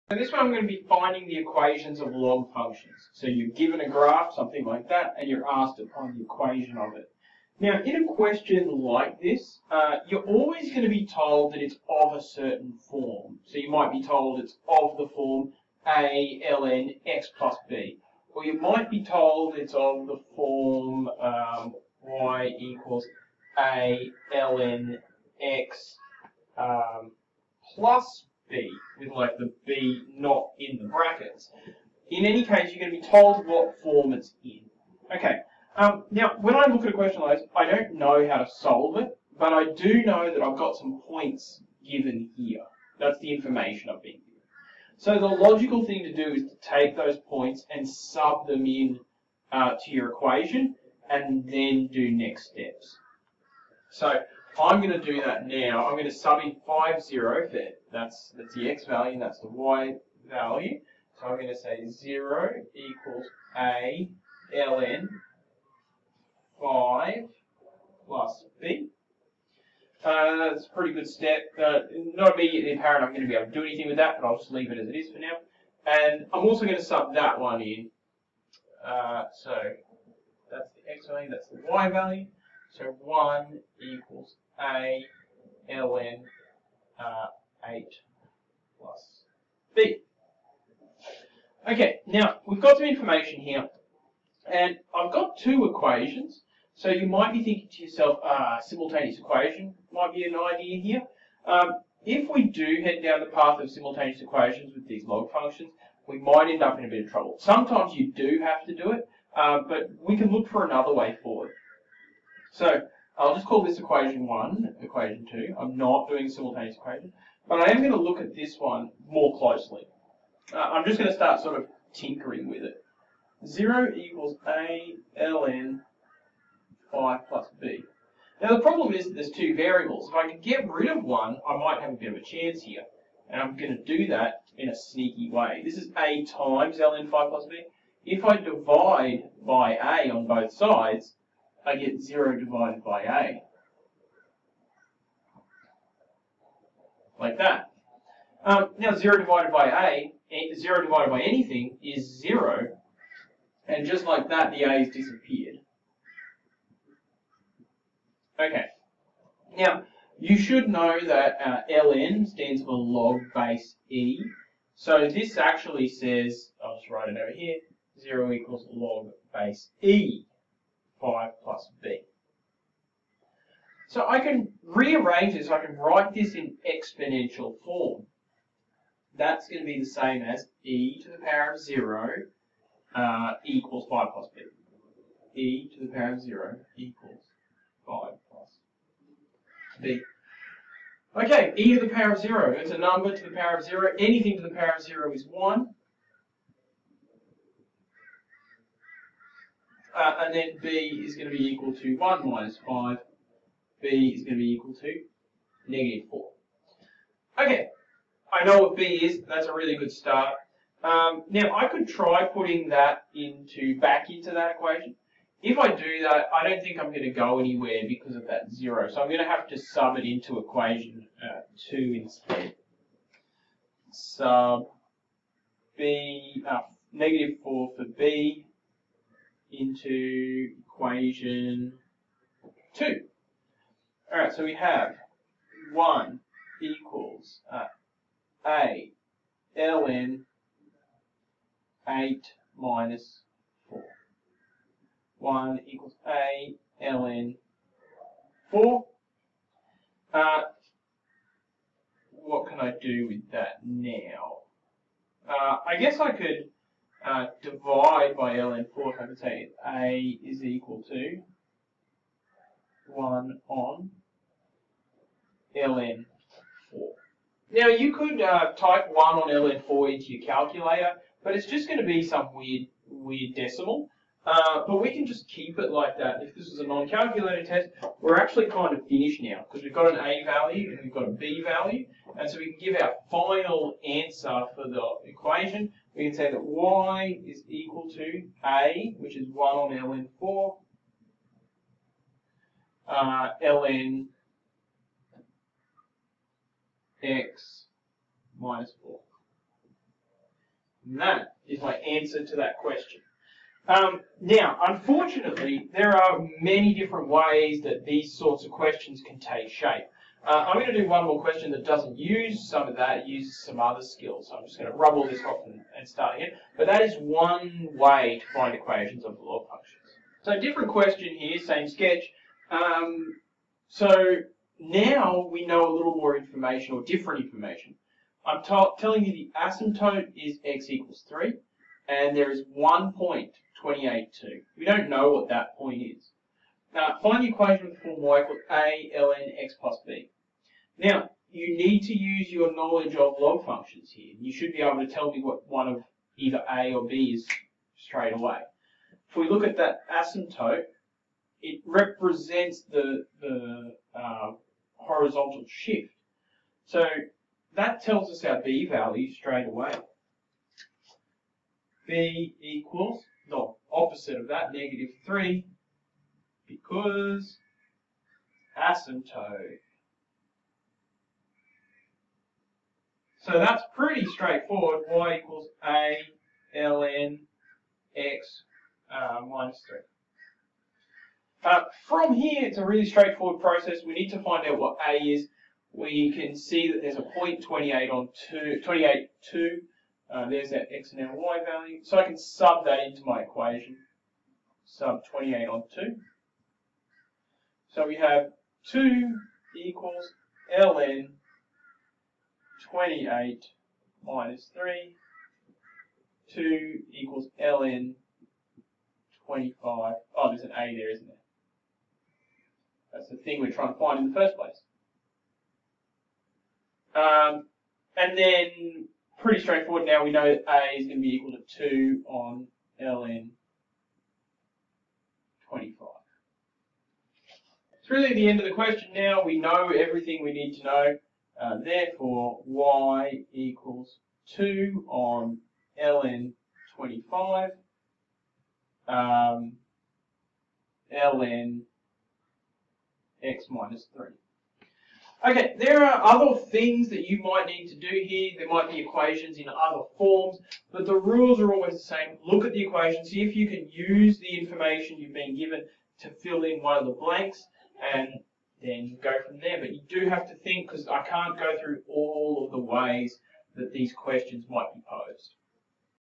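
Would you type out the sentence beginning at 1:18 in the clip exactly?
Uh, so that's the x value, that's the y value.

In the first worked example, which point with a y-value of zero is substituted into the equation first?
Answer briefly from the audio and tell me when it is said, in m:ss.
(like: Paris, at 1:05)
(5, 0), at 0:56.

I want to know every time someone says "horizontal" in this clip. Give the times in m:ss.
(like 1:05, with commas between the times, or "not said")
5:54.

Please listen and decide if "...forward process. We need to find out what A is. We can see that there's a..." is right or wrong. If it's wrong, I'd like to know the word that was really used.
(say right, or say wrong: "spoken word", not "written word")
wrong: "straightforward", not "forward".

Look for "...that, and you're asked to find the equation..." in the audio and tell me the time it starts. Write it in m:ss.
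0:04.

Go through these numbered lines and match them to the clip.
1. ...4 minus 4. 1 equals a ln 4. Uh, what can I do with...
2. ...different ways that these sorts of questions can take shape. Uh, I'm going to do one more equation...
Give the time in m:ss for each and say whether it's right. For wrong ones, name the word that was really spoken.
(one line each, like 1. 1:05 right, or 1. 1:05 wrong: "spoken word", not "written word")
1. 4:01 wrong: "8", not "4"
2. 5:06 wrong: "question", not "equation".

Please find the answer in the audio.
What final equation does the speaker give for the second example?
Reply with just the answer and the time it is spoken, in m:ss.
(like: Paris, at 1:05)
y = (2/ln 25) ln x - 3, at 7:12.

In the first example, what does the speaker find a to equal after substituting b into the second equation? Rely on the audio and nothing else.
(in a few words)
1 on ln 4.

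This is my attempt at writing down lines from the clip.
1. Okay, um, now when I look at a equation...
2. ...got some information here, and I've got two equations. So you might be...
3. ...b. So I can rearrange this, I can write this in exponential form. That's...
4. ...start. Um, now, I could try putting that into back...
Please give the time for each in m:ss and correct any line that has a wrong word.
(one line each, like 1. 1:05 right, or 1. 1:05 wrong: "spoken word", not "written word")
1. 0:35 wrong: "question", not "equation"
2. 1:32 right
3. 2:51 right
4. 3:29 right.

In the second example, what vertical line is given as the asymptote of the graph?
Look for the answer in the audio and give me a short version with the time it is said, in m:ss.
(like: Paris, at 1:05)
x = 3, at 5:30.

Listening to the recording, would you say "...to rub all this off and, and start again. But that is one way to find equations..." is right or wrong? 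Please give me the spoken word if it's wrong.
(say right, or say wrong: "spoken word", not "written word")
right.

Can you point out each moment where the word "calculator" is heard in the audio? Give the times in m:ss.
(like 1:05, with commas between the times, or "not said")
4:30, 4:36.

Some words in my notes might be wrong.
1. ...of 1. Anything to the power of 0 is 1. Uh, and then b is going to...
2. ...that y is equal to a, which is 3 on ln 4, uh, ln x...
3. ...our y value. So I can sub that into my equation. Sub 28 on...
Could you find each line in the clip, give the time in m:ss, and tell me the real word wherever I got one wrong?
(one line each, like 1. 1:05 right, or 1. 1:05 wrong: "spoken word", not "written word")
1. 3:13 wrong: "0", not "1"
2. 4:46 wrong: "1", not "3"
3. 6:31 right.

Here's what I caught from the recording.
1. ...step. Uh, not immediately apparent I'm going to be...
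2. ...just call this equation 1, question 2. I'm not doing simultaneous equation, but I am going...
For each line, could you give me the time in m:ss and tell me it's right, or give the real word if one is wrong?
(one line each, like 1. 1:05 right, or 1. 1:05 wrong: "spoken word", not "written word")
1. 1:11 right
2. 1:53 wrong: "equation", not "question".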